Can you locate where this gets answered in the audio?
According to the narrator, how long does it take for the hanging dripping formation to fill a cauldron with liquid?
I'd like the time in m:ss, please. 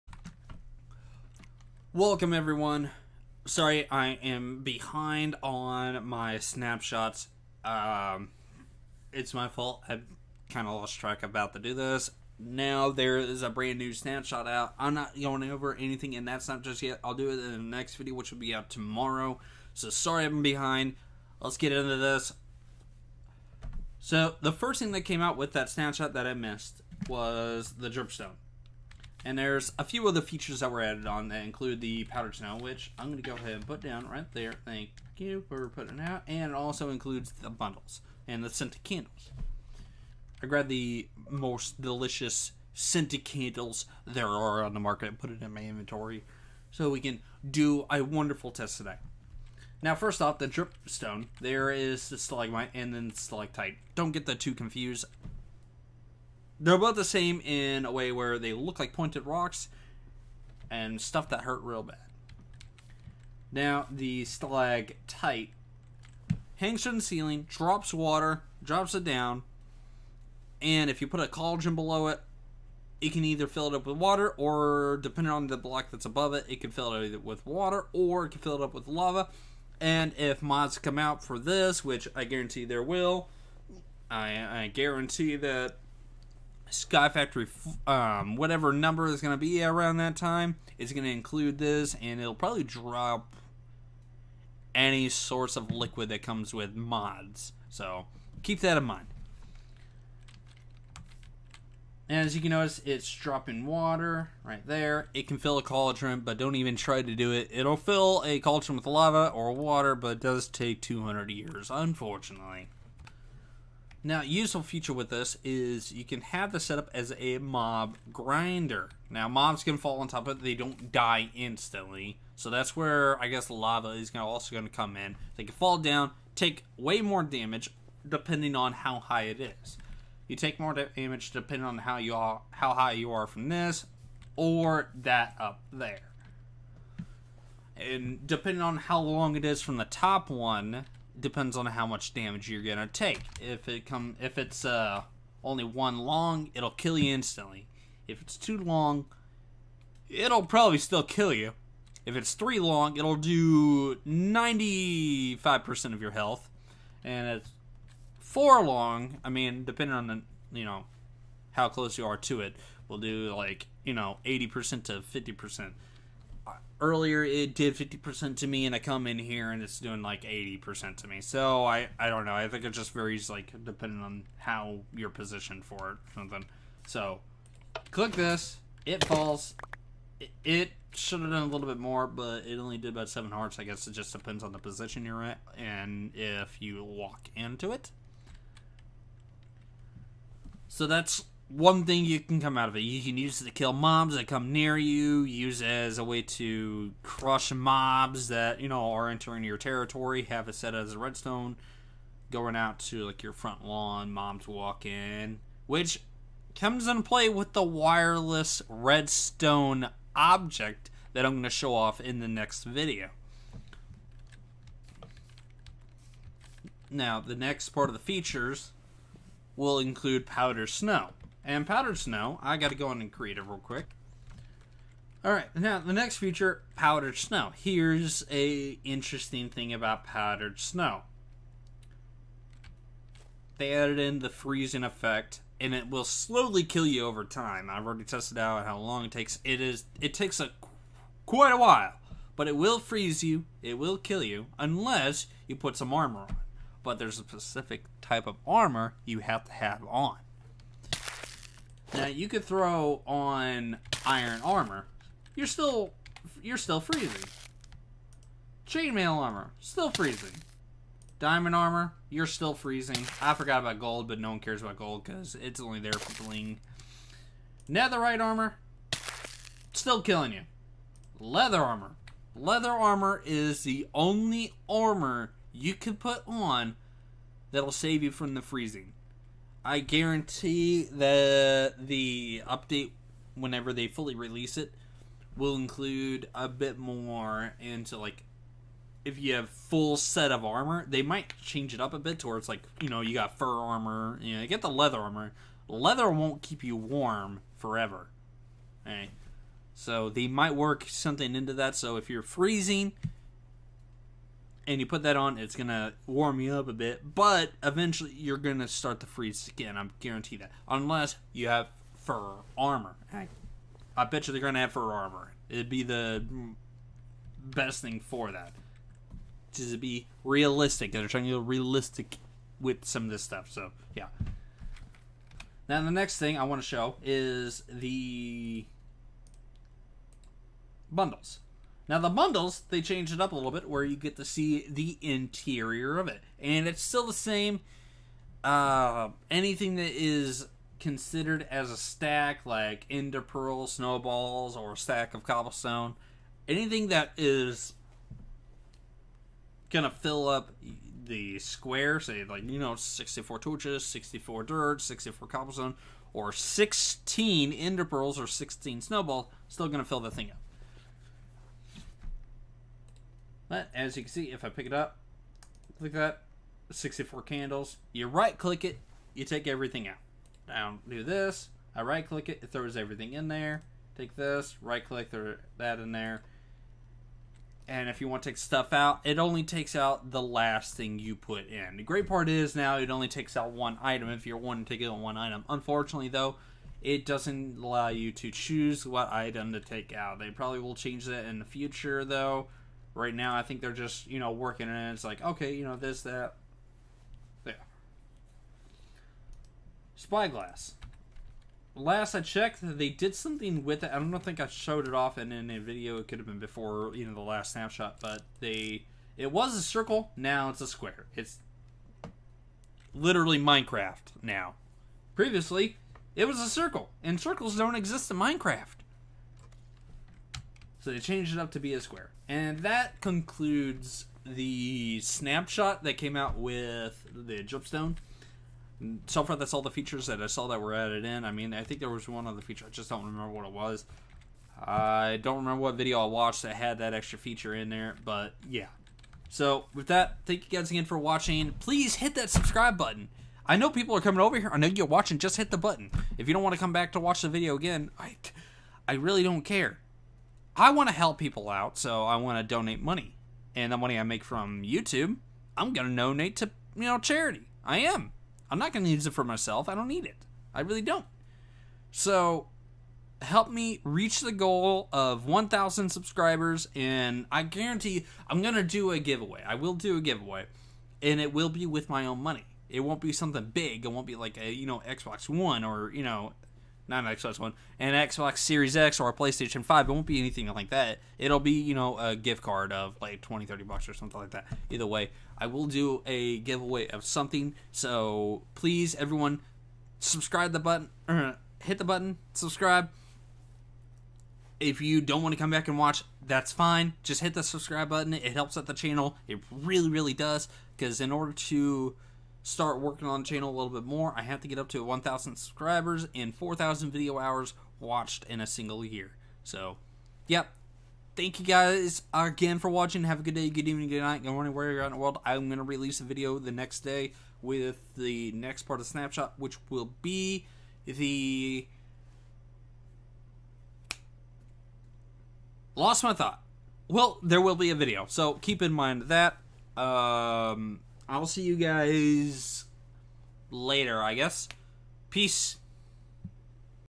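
1:50.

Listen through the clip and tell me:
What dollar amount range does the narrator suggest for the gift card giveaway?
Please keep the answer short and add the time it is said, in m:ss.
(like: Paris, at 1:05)
20 to 30 dollars, at 8:03.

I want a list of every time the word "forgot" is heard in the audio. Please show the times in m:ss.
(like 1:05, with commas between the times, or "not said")
4:23.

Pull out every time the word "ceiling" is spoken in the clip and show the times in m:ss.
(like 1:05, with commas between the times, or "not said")
1:07.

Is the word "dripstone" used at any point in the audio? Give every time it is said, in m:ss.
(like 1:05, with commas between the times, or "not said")
0:27, 0:50, 7:07.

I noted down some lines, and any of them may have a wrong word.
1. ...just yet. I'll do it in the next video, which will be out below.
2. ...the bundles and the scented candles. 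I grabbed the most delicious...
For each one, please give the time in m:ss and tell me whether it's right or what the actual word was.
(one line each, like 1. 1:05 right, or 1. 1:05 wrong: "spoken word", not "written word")
1. 0:16 wrong: "tomorrow", not "below"
2. 0:37 right.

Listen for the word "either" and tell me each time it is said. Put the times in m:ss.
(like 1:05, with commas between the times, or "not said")
1:13, 8:04.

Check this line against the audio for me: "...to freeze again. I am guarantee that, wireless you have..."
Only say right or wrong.
wrong.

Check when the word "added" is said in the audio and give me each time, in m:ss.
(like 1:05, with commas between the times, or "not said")
0:30, 3:53, 7:10.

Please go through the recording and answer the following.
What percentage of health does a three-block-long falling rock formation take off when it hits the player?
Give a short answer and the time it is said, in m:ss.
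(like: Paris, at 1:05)
95%, at 2:33.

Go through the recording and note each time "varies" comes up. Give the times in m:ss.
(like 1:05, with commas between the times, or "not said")
2:52.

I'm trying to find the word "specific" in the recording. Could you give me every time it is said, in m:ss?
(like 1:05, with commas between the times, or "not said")
4:07.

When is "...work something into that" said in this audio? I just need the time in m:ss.
5:00.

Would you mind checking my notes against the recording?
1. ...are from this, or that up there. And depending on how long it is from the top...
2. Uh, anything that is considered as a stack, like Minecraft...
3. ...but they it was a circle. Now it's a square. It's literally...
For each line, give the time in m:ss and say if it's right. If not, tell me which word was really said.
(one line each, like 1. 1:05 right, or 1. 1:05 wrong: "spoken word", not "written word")
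1. 2:13 right
2. 5:38 wrong: "Ender", not "Minecraft"
3. 6:48 right.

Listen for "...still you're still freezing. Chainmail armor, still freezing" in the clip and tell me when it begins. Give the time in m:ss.
4:15.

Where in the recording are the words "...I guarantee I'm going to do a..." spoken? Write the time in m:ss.
7:47.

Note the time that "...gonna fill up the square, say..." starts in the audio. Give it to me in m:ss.
5:49.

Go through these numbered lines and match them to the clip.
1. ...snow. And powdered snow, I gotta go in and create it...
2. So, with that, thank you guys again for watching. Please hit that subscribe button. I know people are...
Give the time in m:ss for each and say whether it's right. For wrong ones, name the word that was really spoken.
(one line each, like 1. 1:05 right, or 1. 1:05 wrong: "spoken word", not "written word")
1. 3:40 right
2. 7:19 right.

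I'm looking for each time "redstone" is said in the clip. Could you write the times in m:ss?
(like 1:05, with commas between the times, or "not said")
3:20, 3:28.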